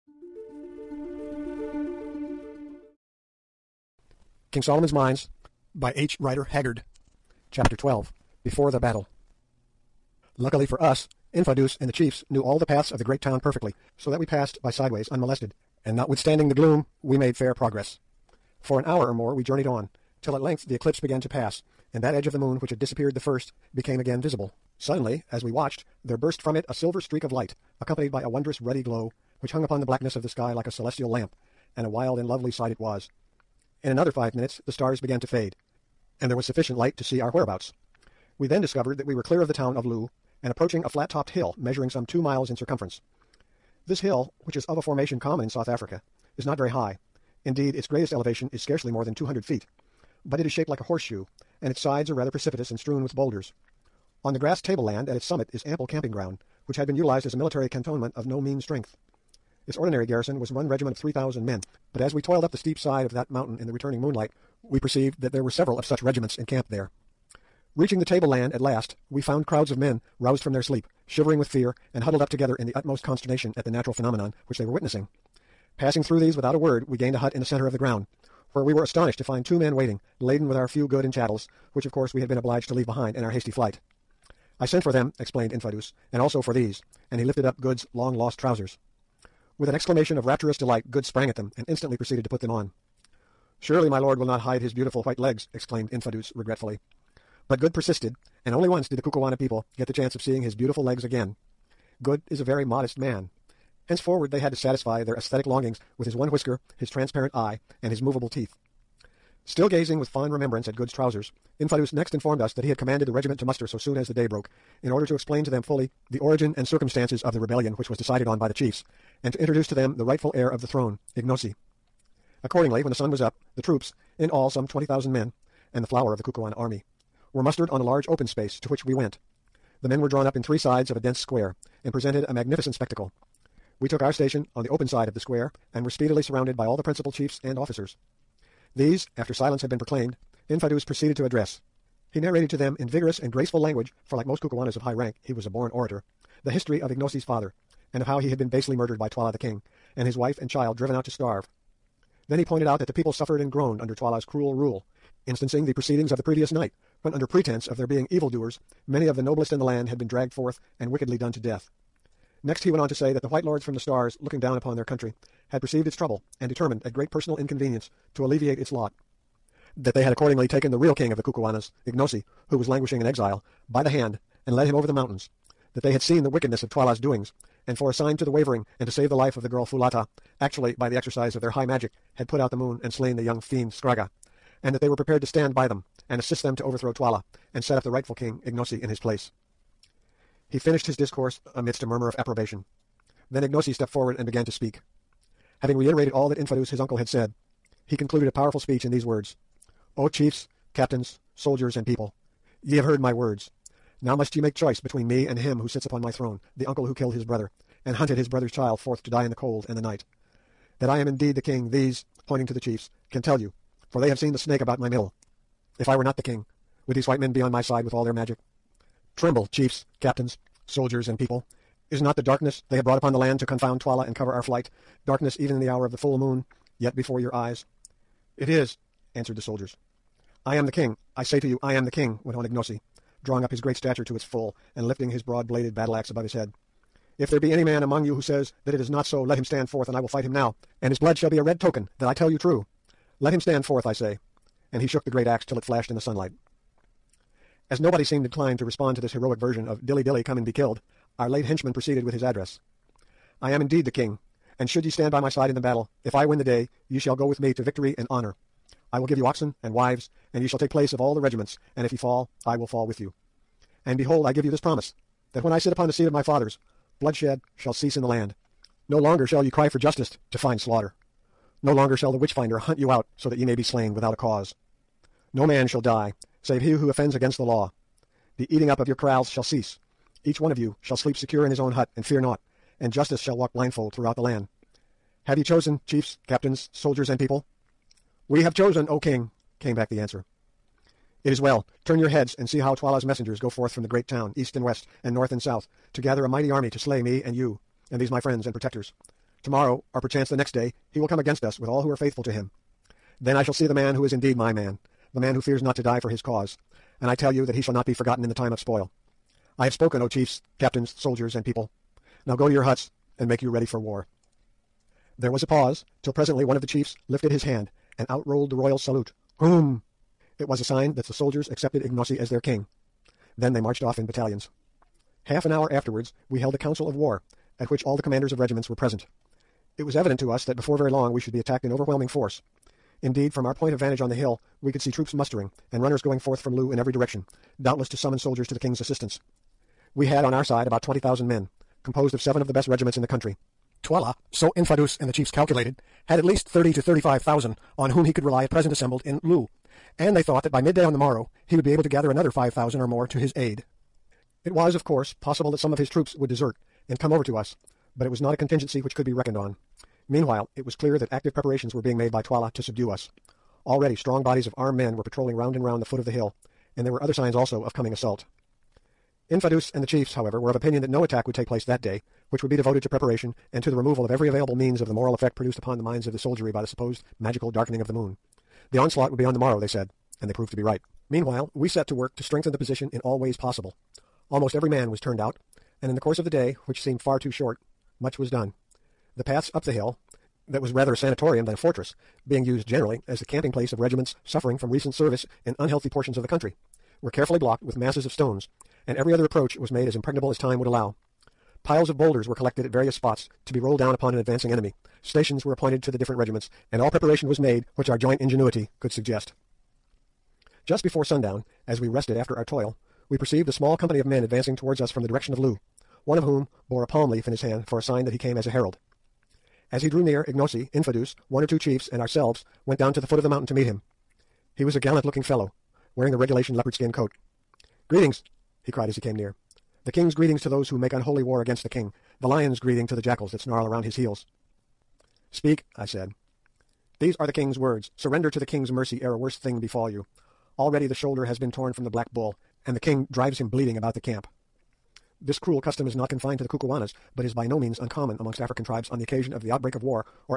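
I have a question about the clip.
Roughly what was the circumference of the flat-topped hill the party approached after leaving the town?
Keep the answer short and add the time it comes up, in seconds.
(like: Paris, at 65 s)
2 miles, at 42 s.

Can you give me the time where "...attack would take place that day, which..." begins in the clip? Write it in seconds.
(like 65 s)
371 s.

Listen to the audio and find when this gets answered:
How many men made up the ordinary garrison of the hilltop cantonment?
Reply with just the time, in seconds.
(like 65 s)
60 s.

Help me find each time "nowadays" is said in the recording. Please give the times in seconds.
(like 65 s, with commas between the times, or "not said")
not said.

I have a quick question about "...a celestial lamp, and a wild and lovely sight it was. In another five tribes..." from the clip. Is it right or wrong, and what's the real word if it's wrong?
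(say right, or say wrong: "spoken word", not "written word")
wrong: "minutes", not "tribes".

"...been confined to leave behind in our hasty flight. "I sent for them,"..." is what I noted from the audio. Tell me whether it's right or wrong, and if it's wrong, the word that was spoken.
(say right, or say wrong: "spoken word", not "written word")
wrong: "obliged", not "confined".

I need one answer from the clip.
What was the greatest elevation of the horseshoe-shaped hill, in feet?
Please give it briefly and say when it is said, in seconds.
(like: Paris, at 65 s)
200, at 49 s.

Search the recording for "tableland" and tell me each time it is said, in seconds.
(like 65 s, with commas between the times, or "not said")
54 s, 68 s.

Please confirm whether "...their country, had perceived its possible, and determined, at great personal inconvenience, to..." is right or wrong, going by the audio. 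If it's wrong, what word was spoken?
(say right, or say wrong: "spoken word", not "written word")
wrong: "trouble", not "possible".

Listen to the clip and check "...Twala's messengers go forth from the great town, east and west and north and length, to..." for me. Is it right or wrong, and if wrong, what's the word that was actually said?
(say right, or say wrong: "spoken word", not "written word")
wrong: "south", not "length".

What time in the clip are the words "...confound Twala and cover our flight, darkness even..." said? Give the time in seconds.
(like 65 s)
223 s.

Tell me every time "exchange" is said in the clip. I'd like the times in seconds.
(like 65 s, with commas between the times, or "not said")
not said.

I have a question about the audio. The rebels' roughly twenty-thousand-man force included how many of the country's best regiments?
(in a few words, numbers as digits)
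7.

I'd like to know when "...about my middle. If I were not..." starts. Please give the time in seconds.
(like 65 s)
214 s.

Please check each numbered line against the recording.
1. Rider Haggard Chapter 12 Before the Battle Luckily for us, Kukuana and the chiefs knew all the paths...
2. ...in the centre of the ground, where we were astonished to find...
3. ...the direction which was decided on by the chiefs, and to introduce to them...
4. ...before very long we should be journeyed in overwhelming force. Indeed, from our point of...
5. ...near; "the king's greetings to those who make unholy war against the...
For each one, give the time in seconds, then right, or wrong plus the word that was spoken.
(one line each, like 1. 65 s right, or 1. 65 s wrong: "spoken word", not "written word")
1. 6 s wrong: "Infadoos", not "Kukuana"
2. 77 s right
3. 117 s wrong: "rebellion", not "direction"
4. 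330 s wrong: "attacked", not "journeyed"
5. 429 s right.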